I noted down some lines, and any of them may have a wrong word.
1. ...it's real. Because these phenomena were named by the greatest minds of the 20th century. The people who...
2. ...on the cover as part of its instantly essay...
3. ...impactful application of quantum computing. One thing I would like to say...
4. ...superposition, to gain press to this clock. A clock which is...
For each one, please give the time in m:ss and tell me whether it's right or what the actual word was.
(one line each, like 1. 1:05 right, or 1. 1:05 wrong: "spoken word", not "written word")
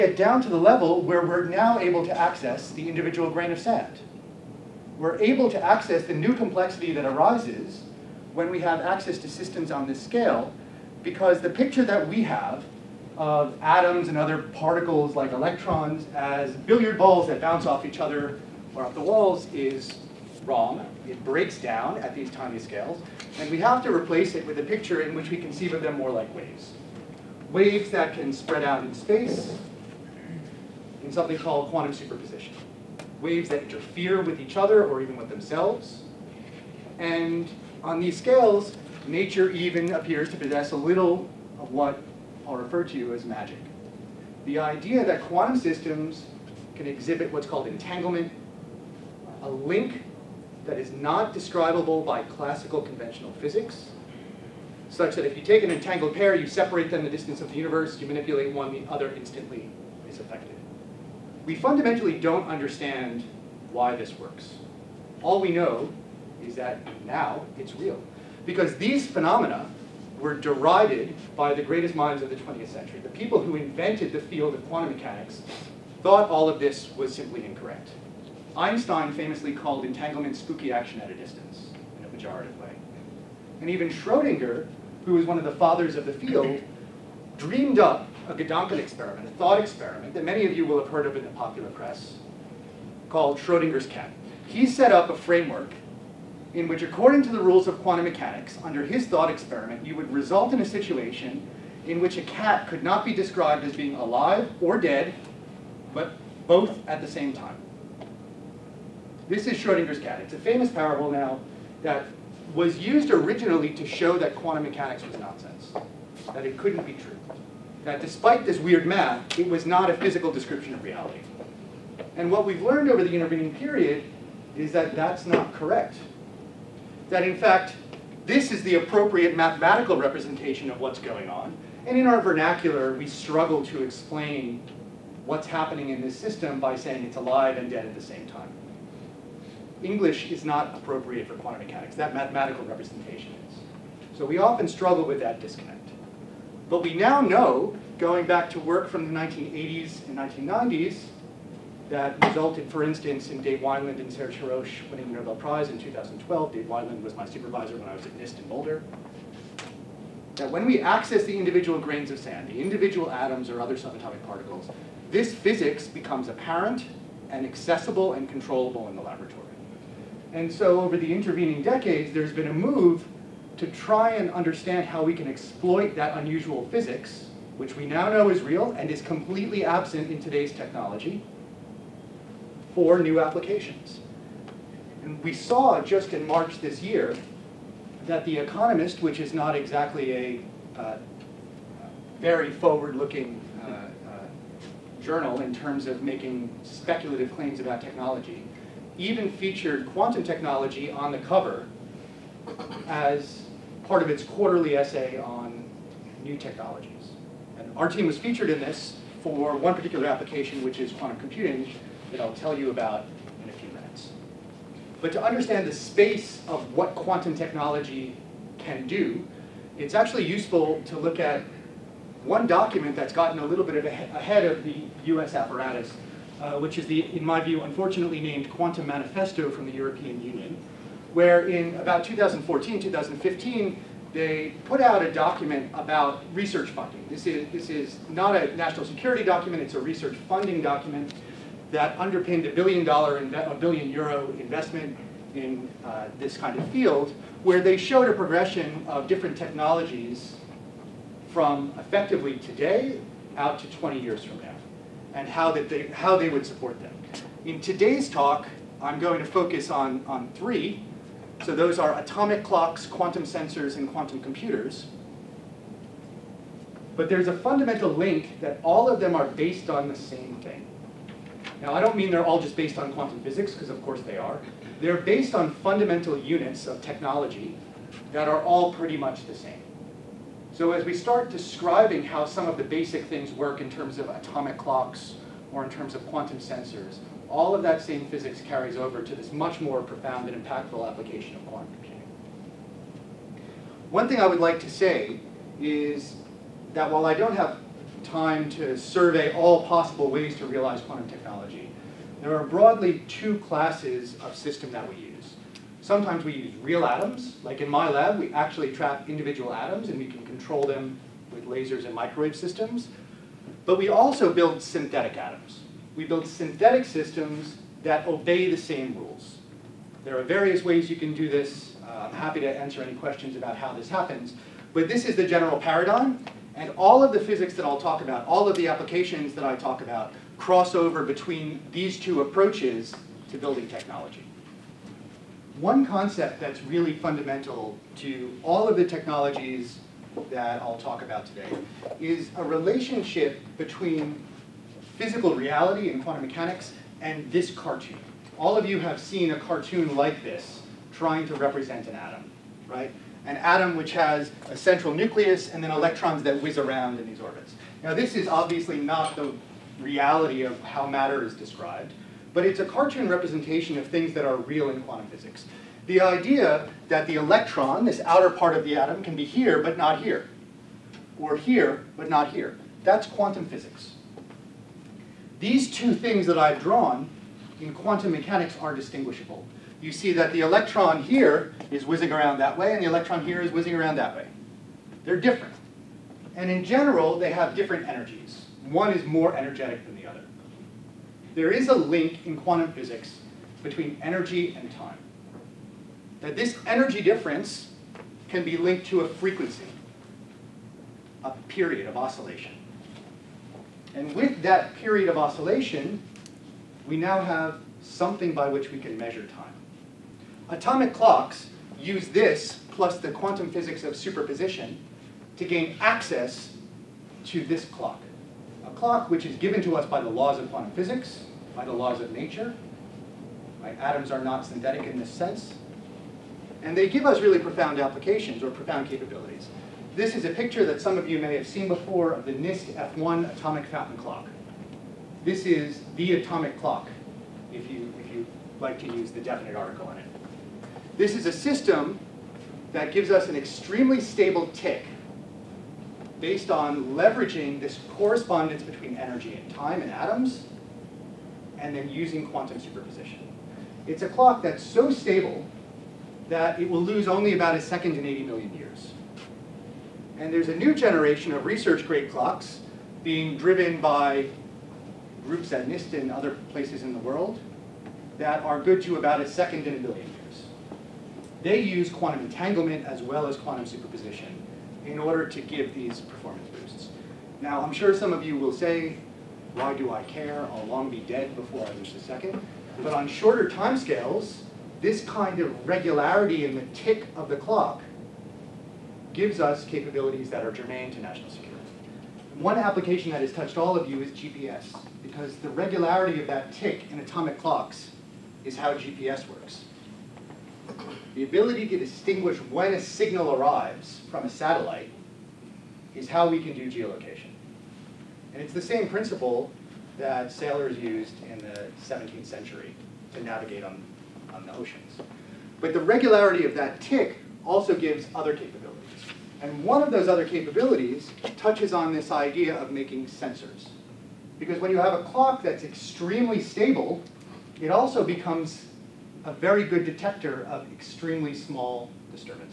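1. 1:07 wrong: "derided", not "named"
2. 3:20 wrong: "quarterly", not "instantly"
3. 4:50 right
4. 6:53 wrong: "access", not "press".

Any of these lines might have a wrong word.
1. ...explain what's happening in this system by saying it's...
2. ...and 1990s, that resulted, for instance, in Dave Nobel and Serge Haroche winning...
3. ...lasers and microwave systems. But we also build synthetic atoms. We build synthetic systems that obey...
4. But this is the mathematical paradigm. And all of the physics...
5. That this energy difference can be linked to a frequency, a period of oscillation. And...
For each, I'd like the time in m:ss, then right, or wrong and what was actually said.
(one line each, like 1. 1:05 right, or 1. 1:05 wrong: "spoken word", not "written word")
1. 2:13 right
2. 2:30 wrong: "Wineland", not "Nobel"
3. 5:11 right
4. 5:24 wrong: "general", not "mathematical"
5. 6:36 right.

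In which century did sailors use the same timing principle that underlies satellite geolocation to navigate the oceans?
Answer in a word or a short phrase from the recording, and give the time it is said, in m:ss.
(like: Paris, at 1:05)
17th century, at 8:31.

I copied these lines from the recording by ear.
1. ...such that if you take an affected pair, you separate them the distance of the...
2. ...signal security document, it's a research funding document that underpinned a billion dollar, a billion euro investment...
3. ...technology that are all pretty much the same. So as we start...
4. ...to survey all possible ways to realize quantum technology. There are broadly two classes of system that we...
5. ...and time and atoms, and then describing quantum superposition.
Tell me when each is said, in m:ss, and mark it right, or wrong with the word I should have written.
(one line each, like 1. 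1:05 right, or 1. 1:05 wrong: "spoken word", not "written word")
1. 0:54 wrong: "entangled", not "affected"
2. 3:58 wrong: "national", not "signal"
3. 4:36 right
4. 4:58 right
5. 7:29 wrong: "using", not "describing".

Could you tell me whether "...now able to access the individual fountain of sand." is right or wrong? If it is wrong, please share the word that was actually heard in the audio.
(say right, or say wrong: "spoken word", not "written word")
wrong: "grain", not "fountain".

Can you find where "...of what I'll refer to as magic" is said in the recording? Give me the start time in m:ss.
0:41.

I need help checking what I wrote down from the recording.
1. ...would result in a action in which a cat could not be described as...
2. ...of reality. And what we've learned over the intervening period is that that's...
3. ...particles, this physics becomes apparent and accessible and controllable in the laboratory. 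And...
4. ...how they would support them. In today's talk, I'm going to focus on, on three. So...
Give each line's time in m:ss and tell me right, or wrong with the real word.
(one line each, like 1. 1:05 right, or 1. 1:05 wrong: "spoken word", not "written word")
1. 1:39 wrong: "situation", not "action"
2. 2:00 right
3. 2:44 right
4. 4:15 right.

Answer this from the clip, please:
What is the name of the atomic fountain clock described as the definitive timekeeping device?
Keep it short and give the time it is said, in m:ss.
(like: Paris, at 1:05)
NIST F1, at 7:12.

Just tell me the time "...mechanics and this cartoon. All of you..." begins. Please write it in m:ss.
5:46.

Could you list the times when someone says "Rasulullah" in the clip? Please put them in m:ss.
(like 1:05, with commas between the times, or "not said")
not said.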